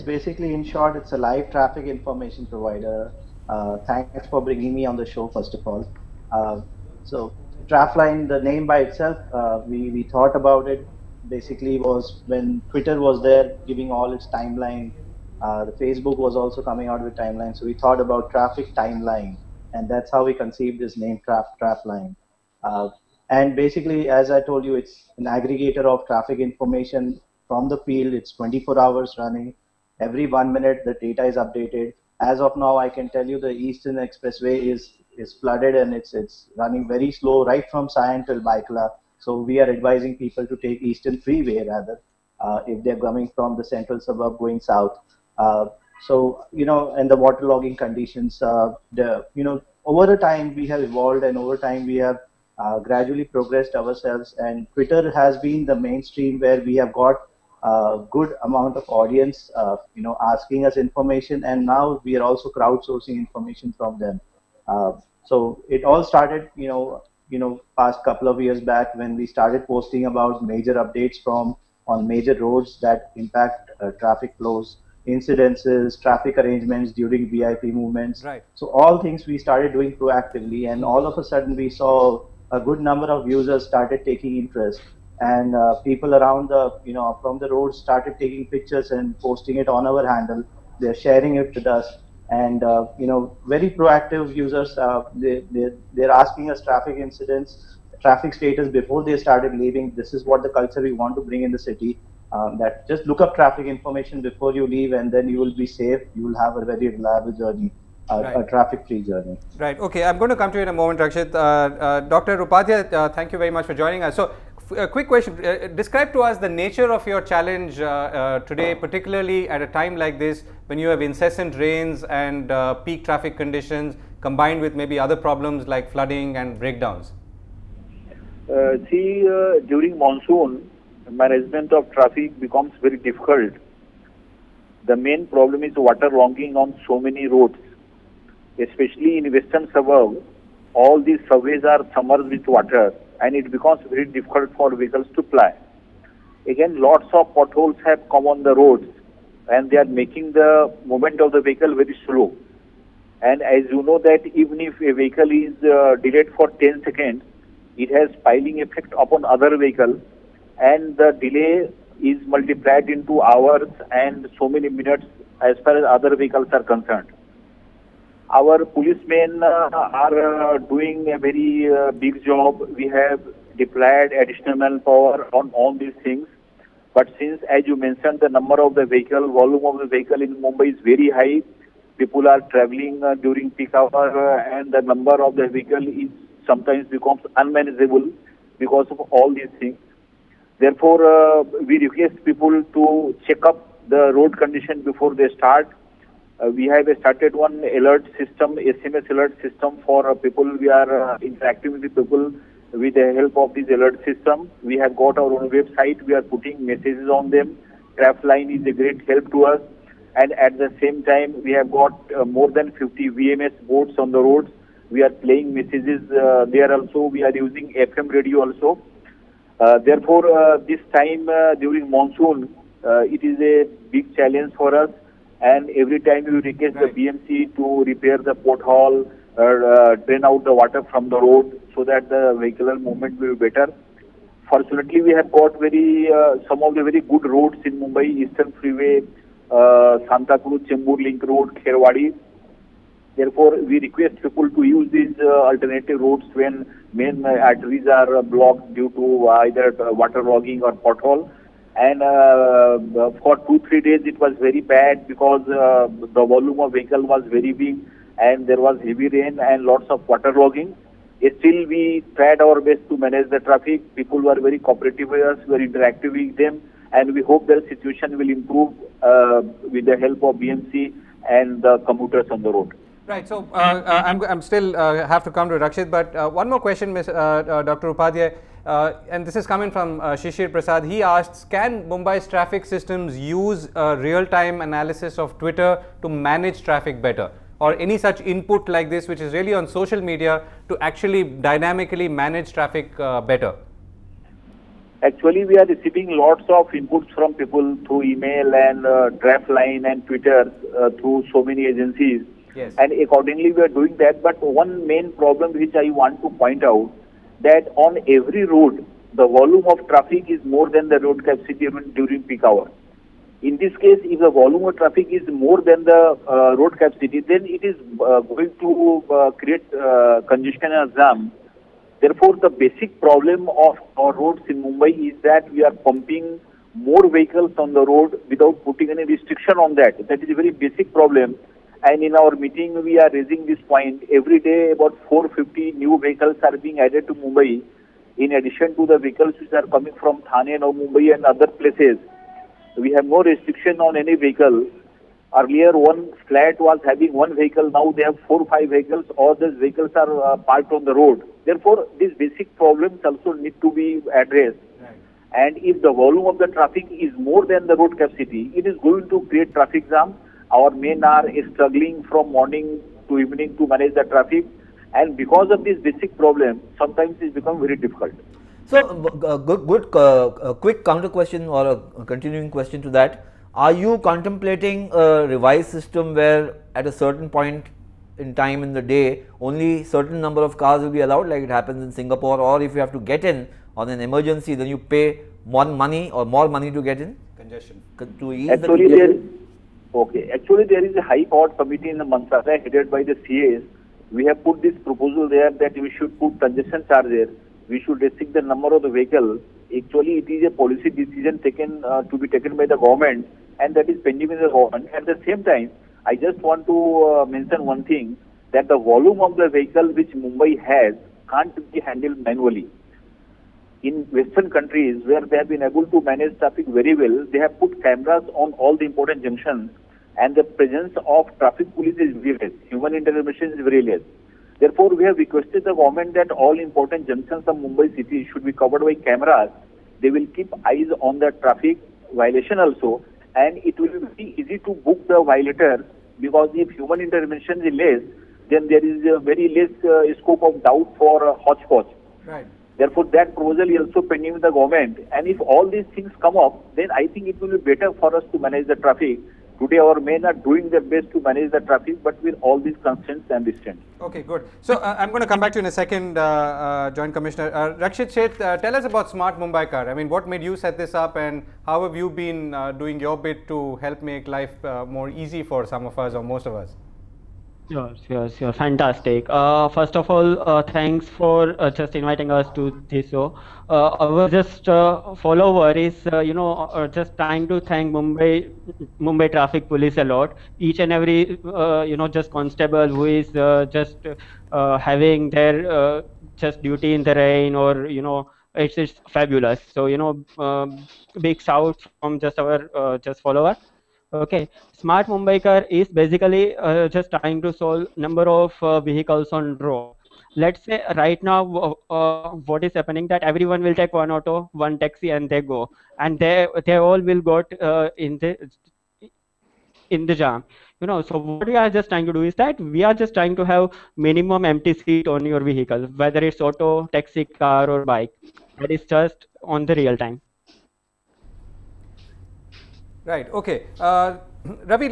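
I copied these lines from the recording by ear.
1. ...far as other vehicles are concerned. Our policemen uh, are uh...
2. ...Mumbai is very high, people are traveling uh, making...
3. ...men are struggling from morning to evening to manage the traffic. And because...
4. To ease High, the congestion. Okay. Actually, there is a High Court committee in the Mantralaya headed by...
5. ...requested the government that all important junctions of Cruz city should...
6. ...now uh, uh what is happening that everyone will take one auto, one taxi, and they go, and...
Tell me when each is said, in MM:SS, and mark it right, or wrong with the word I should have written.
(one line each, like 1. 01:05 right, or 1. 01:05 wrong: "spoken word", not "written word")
1. 02:45 right
2. 03:00 wrong: "during", not "making"
3. 06:00 right
4. 06:28 wrong: "Actually", not "High"
5. 07:05 wrong: "Mumbai", not "Cruz"
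6. 08:21 right.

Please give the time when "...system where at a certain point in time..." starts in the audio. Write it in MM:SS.
06:15.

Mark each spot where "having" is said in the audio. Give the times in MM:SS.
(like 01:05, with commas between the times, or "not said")
05:46, 08:04.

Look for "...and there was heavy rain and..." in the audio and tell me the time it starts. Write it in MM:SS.
04:18.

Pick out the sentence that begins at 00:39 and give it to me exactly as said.
So we are advising people to take Eastern Freeway rather uh, if they're coming from the central suburb going south.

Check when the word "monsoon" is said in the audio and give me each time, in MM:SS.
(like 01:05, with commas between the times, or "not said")
02:09, 03:41.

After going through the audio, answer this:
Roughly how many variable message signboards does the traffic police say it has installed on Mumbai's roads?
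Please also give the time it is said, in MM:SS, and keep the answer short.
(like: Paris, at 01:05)
more than 50, at 03:32.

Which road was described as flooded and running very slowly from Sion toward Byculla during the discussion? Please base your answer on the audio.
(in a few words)
Eastern Expressway.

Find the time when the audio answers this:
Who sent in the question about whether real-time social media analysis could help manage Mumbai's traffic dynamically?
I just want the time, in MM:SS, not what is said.
04:40.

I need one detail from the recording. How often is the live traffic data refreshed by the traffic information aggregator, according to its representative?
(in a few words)
Every one minute.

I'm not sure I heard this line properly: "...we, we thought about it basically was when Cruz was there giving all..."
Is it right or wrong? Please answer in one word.
wrong.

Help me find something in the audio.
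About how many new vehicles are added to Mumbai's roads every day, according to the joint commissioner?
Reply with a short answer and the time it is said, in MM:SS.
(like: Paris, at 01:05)
450, at 05:35.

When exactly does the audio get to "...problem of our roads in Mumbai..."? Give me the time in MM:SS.
05:22.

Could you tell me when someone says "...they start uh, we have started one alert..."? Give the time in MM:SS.
03:15.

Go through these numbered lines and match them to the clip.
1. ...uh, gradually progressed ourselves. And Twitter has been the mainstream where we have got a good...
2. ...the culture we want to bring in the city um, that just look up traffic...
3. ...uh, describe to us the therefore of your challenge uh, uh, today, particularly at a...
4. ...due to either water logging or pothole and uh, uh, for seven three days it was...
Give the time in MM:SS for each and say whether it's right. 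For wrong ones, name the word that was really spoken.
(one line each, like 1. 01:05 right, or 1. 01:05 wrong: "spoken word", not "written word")
1. 00:52 right
2. 01:40 right
3. 01:55 wrong: "nature", not "therefore"
4. 04:08 wrong: "two", not "seven".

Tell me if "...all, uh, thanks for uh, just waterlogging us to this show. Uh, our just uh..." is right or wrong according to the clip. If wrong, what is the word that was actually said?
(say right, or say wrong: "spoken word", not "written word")
wrong: "inviting", not "waterlogging".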